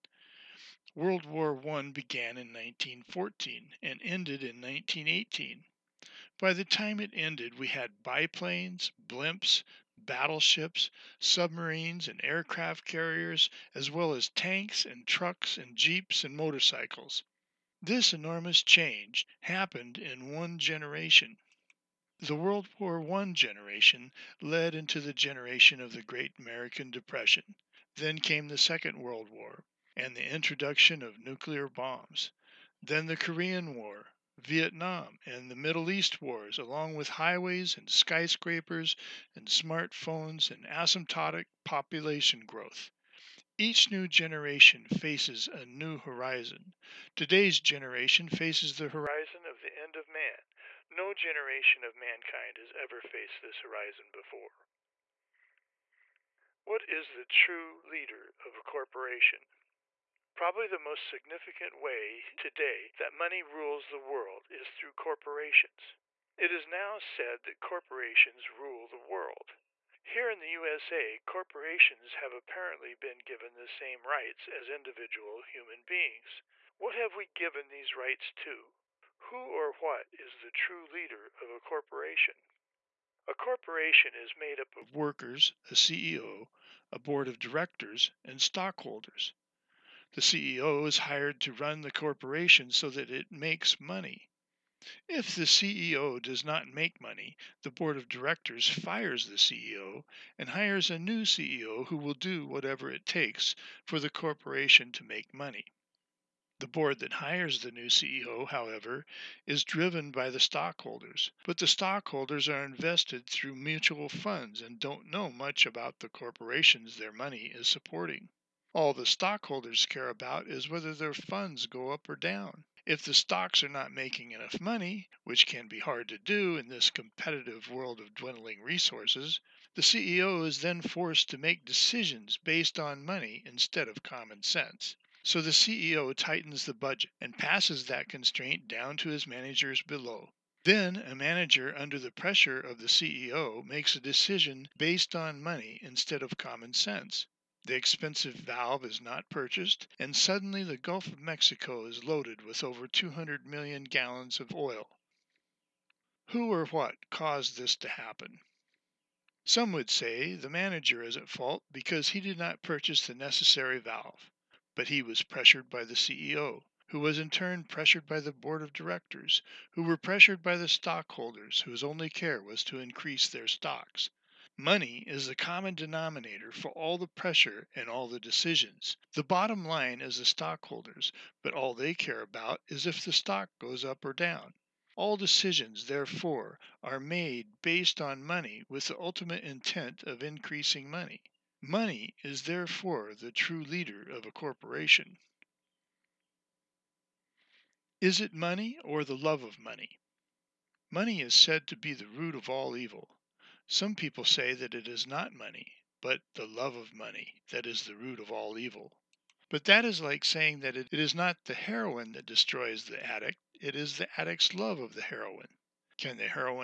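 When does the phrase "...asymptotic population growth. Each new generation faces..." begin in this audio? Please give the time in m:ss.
0:40.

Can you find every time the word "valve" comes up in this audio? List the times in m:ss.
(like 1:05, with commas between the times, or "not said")
2:28, 2:43.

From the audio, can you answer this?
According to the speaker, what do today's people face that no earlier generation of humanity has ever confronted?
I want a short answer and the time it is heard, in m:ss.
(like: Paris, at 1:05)
The end of man, at 0:49.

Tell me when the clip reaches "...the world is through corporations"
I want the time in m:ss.
1:03.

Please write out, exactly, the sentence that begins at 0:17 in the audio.
This enormous change happened in one generation.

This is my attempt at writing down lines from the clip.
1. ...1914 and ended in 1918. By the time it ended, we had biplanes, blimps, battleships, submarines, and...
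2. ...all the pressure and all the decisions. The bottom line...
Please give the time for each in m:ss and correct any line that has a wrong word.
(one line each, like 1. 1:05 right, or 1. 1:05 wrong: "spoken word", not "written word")
1. 0:02 right
2. 2:56 right.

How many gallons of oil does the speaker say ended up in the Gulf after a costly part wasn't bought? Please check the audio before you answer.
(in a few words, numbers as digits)
200,000,000.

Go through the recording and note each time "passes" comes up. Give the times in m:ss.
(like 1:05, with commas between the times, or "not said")
2:17.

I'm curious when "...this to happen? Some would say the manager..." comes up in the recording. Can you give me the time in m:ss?
2:37.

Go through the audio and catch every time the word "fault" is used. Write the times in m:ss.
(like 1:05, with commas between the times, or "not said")
2:41.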